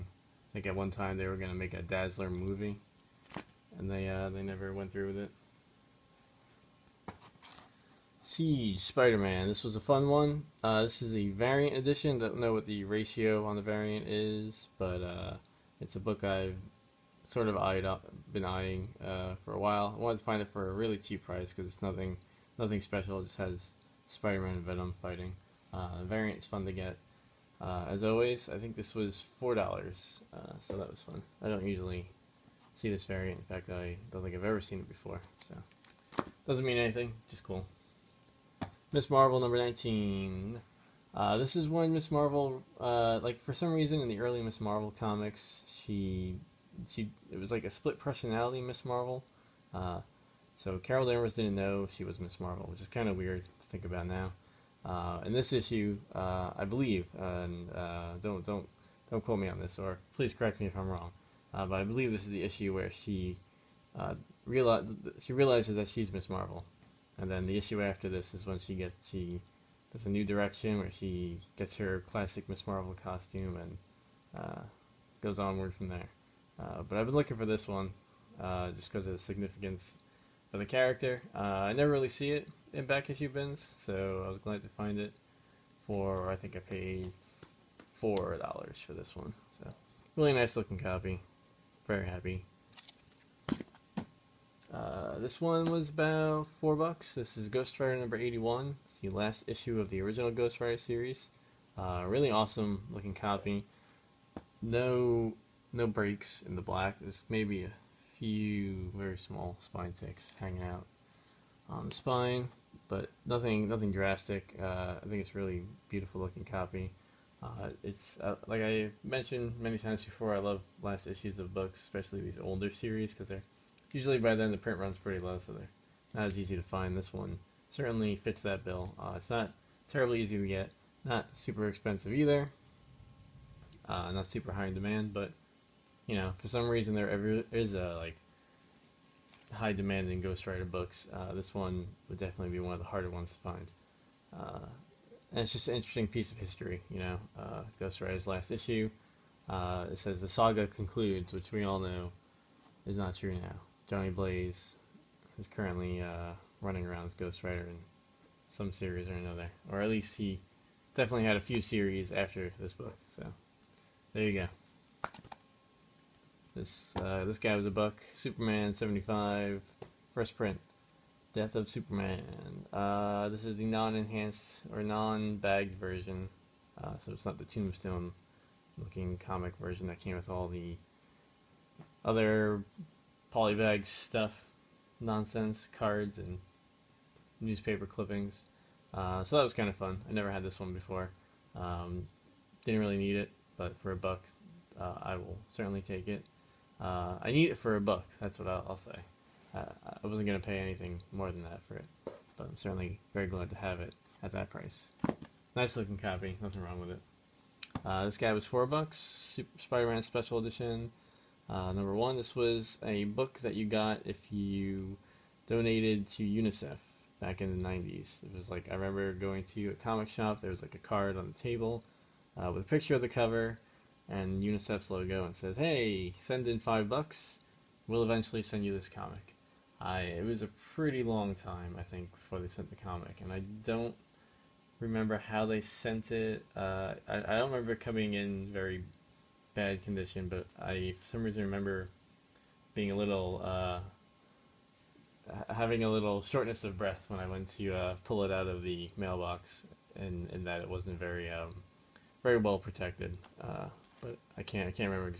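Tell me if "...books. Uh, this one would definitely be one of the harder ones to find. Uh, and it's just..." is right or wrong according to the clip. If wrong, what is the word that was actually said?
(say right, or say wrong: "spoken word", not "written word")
right.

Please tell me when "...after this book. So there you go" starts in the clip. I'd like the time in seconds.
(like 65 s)
162 s.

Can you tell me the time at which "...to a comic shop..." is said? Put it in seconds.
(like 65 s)
219 s.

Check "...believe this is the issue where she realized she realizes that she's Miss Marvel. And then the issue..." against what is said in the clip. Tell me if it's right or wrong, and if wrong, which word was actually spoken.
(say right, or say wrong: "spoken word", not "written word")
right.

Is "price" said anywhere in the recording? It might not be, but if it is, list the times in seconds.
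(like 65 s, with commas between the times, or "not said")
21 s, 204 s.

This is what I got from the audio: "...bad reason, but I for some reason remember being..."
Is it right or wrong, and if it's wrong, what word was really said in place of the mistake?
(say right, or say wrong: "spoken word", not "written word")
wrong: "condition", not "reason".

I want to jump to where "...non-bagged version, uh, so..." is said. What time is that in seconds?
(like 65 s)
174 s.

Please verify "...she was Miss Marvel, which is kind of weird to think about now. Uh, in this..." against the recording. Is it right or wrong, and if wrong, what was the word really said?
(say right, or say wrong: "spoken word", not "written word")
right.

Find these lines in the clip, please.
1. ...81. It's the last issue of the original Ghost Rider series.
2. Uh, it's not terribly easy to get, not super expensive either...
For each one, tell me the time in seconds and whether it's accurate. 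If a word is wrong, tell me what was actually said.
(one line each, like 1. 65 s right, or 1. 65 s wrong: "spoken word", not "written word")
1. 98 s right
2. 128 s right.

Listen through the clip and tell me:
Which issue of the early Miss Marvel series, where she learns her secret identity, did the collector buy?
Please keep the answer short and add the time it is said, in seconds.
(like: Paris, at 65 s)
19, at 39 s.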